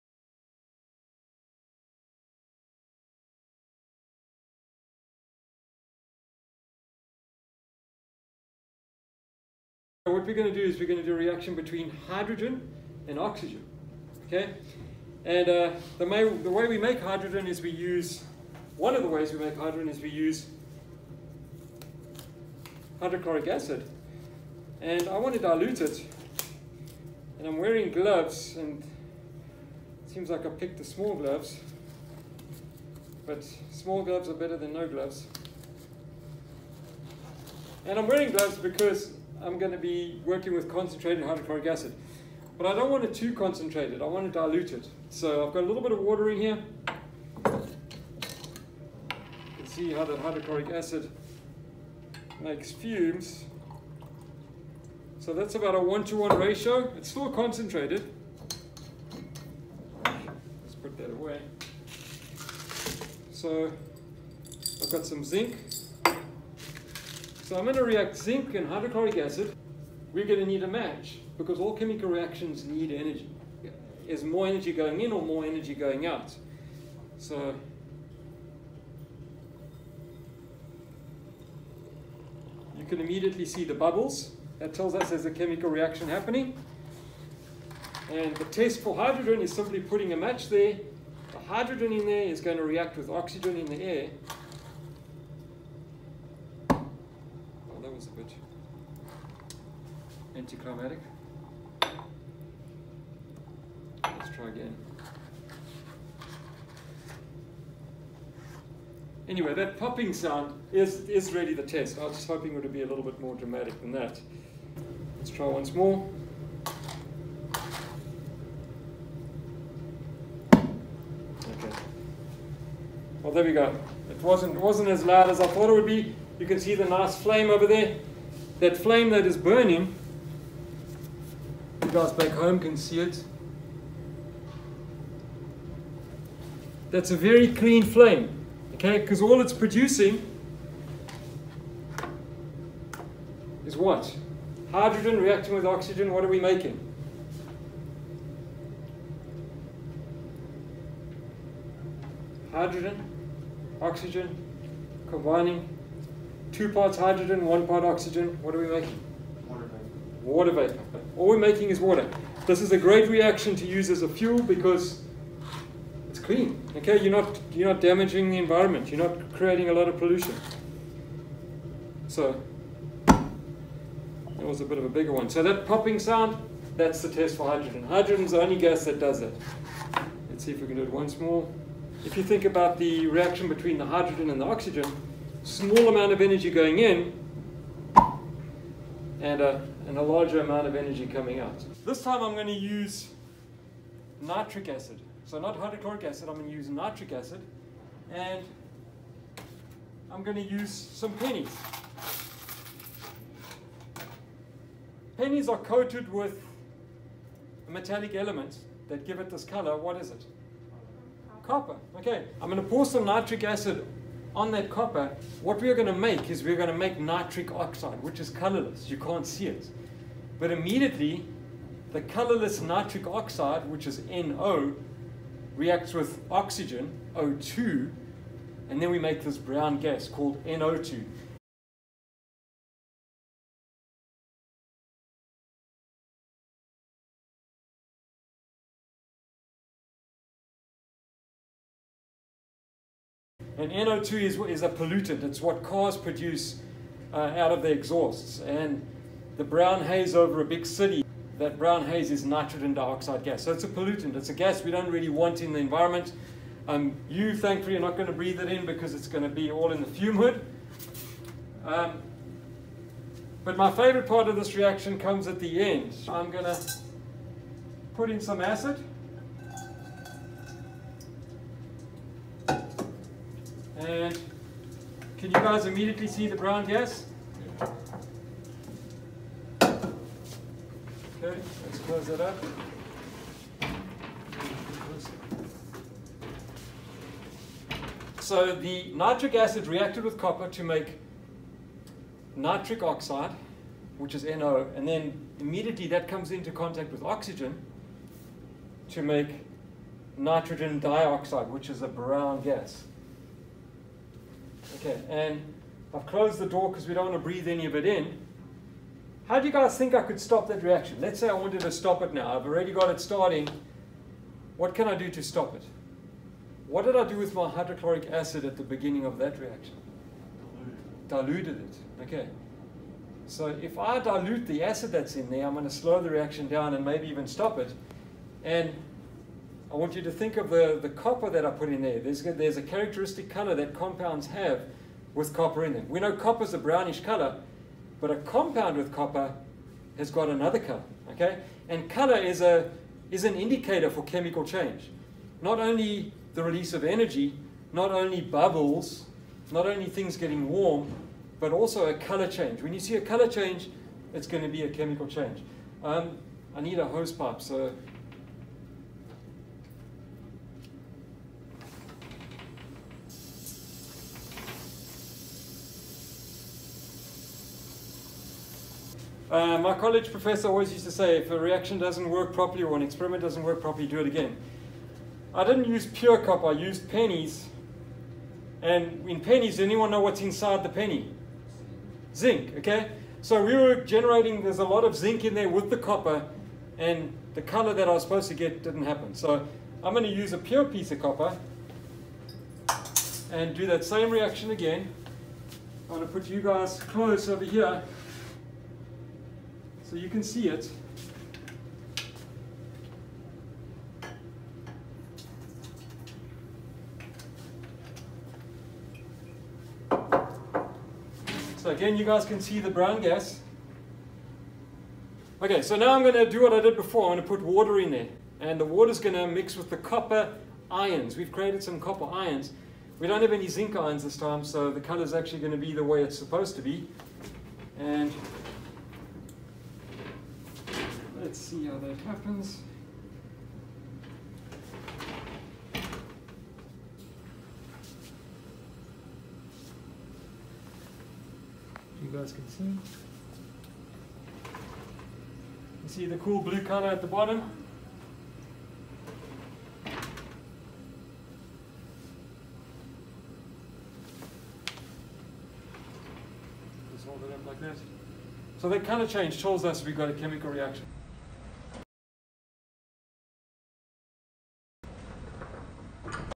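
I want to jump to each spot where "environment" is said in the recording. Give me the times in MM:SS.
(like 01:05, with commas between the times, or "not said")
02:48, 04:15.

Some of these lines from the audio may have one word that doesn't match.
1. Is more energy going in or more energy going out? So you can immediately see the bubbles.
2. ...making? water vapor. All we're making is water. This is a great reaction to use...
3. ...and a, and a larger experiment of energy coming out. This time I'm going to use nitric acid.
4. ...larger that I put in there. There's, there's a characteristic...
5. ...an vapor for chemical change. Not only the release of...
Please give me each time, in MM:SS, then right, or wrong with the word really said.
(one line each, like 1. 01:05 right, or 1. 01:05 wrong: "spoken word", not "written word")
1. 01:14 right
2. 02:38 right
3. 03:09 wrong: "amount", not "experiment"
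4. 05:30 wrong: "copper", not "larger"
5. 05:43 wrong: "indicator", not "vapor".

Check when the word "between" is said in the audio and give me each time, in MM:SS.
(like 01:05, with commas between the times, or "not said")
00:11, 03:03.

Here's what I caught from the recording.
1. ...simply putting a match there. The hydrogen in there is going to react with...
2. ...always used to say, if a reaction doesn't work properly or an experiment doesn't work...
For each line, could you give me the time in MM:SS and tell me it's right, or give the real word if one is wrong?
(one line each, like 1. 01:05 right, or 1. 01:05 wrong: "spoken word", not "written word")
1. 01:29 right
2. 06:10 right.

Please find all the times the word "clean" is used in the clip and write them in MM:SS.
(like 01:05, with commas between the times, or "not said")
02:17, 02:46.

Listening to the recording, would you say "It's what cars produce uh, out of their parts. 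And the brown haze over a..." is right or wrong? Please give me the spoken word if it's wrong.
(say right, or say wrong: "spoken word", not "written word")
wrong: "exhausts", not "parts".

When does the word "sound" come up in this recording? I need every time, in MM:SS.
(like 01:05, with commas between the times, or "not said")
01:50, 02:55.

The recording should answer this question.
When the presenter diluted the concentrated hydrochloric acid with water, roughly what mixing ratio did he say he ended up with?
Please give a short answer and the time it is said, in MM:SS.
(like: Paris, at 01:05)
1 to 1, at 00:55.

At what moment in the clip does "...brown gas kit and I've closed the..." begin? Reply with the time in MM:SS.
05:01.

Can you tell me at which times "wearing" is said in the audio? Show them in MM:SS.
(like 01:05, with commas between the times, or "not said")
00:27, 00:38.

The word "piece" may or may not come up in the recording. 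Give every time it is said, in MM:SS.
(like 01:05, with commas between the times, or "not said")
06:30.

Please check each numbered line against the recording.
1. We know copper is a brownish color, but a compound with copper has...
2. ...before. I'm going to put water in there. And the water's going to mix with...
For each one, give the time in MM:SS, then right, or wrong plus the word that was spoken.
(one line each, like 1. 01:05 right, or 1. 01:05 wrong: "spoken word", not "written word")
1. 05:35 right
2. 06:56 right.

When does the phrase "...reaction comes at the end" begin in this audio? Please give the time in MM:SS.
04:24.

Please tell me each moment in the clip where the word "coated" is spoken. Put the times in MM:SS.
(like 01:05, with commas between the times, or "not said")
03:25.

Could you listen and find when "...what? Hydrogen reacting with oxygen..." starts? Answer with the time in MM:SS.
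02:23.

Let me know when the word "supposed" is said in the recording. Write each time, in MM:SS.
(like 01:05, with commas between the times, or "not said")
06:28, 07:06.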